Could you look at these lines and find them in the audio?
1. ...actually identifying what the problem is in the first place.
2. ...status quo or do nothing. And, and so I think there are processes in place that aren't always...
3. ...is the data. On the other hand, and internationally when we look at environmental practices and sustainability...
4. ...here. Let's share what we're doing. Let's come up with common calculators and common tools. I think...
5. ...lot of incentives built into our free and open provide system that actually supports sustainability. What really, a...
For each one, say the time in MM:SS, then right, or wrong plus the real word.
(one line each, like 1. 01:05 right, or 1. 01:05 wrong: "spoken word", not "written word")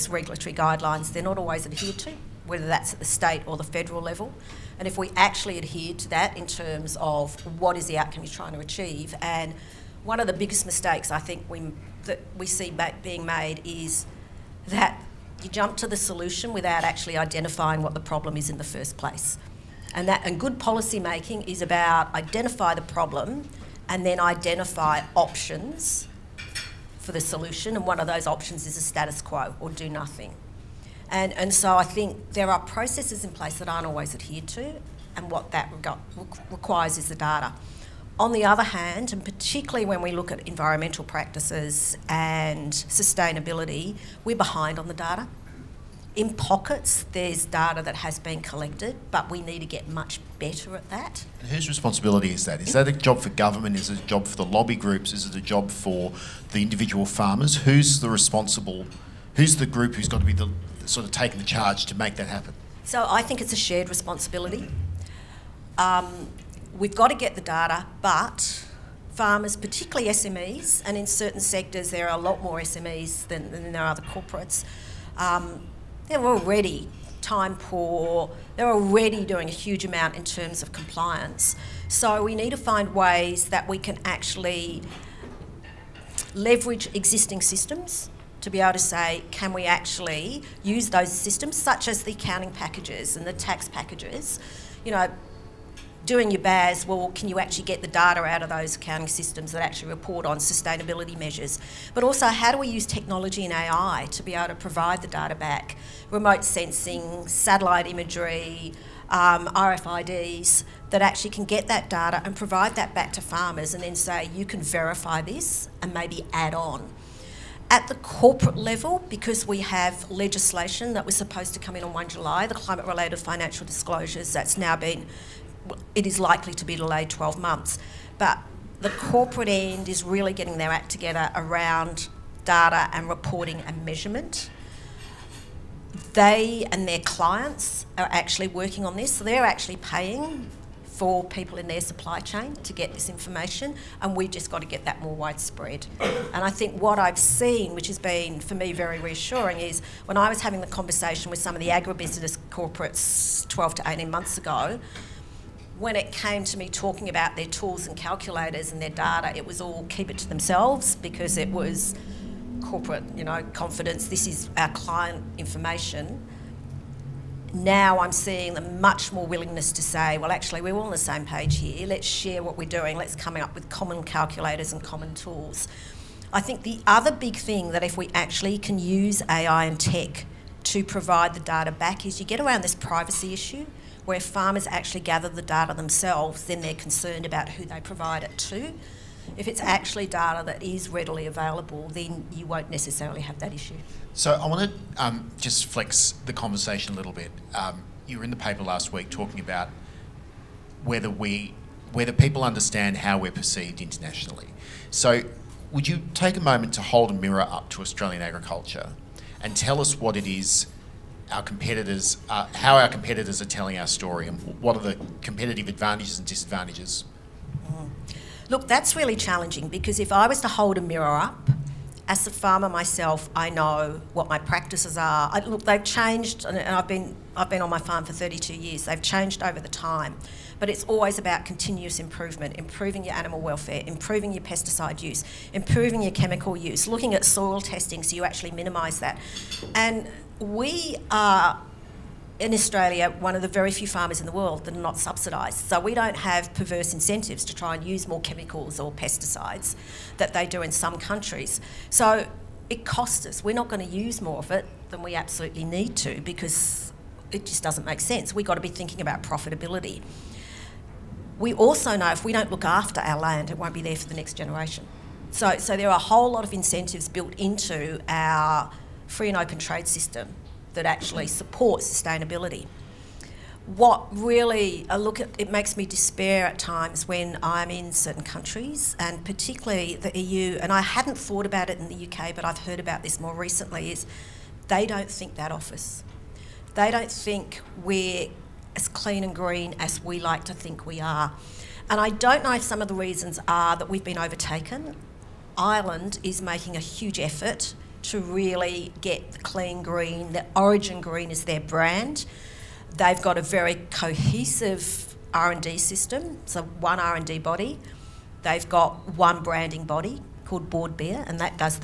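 1. 00:16 right
2. 00:28 right
3. 00:36 wrong: "particularly", not "internationally"
4. 02:51 right
5. 04:26 wrong: "trade", not "provide".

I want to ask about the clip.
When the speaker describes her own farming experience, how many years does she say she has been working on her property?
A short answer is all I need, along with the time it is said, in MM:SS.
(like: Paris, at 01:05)
32 years, at 03:48.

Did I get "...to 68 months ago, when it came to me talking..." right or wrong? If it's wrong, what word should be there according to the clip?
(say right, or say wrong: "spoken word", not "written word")
wrong: "18", not "68".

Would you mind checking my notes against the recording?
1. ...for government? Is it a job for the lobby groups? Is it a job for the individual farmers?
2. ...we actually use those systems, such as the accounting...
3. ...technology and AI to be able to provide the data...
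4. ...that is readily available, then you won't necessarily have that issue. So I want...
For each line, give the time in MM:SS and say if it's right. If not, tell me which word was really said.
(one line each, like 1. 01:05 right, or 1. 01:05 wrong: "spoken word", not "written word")
1. 00:53 right
2. 01:29 right
3. 01:42 right
4. 03:10 right.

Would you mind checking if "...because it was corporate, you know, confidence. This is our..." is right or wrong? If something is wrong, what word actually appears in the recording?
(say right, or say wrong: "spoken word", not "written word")
right.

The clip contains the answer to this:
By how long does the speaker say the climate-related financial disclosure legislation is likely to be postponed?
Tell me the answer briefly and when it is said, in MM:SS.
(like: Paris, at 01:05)
12 months, at 02:07.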